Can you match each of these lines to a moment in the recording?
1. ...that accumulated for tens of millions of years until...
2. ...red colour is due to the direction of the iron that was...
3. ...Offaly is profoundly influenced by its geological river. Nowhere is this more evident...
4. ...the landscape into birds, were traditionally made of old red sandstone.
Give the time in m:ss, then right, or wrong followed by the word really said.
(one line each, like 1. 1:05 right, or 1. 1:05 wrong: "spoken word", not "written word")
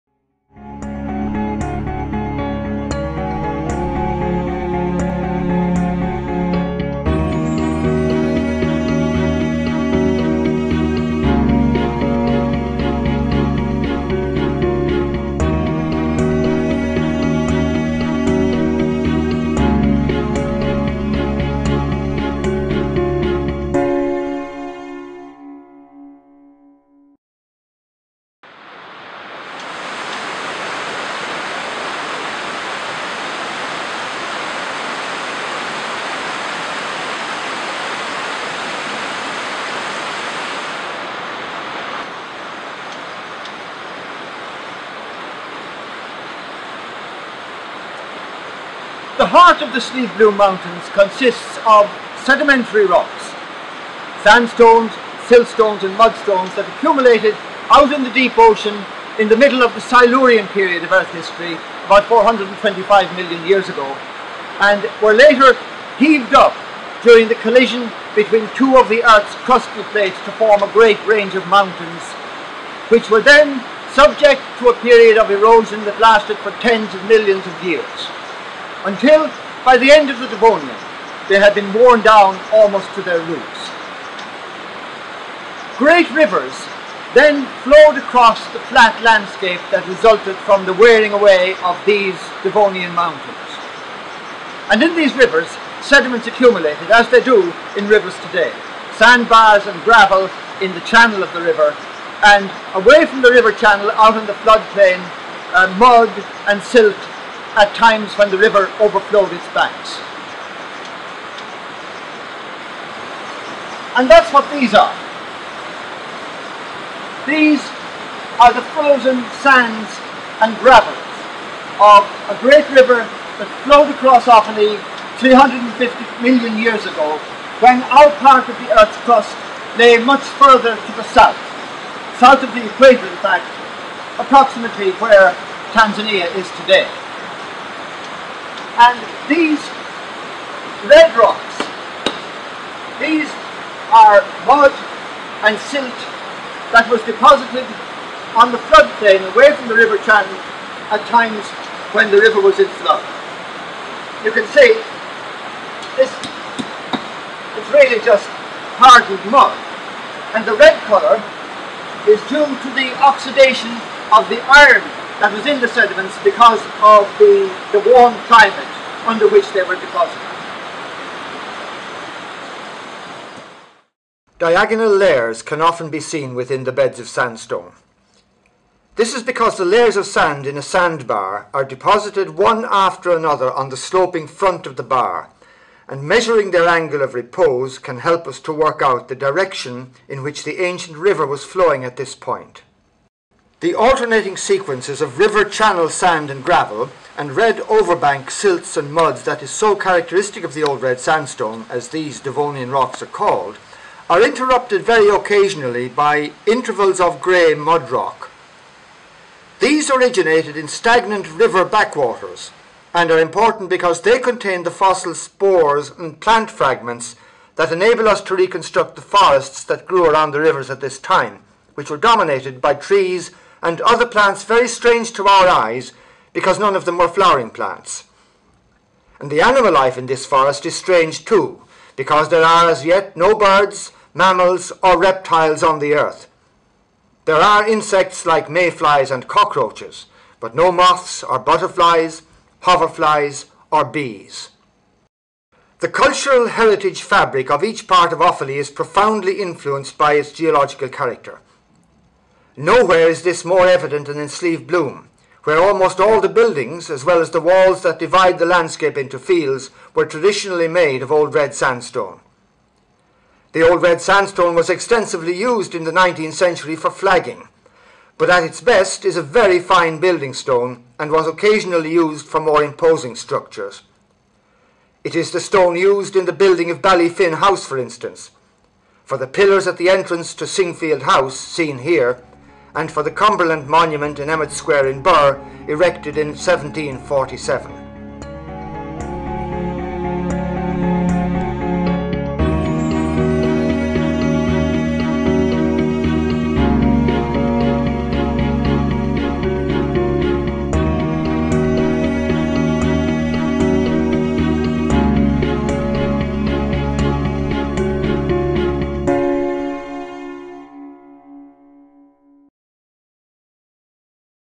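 1. 1:15 wrong: "lasted", not "accumulated"
2. 2:40 wrong: "oxidation", not "direction"
3. 4:08 wrong: "character", not "river"
4. 4:18 wrong: "fields", not "birds".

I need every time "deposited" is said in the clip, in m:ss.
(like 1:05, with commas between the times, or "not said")
2:27, 2:49, 3:01.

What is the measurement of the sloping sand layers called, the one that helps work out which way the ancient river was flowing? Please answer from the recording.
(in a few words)
angle of repose.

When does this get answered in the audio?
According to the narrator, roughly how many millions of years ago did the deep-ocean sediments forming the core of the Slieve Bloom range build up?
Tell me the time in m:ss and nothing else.
1:01.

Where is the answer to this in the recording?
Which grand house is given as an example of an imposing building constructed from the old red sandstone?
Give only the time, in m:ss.
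4:36.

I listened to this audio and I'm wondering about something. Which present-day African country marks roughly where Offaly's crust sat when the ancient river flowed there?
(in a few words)
Tanzania.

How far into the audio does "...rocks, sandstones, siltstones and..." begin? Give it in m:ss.
0:52.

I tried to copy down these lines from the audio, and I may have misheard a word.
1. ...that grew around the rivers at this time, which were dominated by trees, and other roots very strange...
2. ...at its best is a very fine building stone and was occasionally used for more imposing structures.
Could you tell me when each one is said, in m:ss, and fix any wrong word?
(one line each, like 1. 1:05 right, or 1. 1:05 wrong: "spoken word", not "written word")
1. 3:39 wrong: "plants", not "roots"
2. 4:28 right.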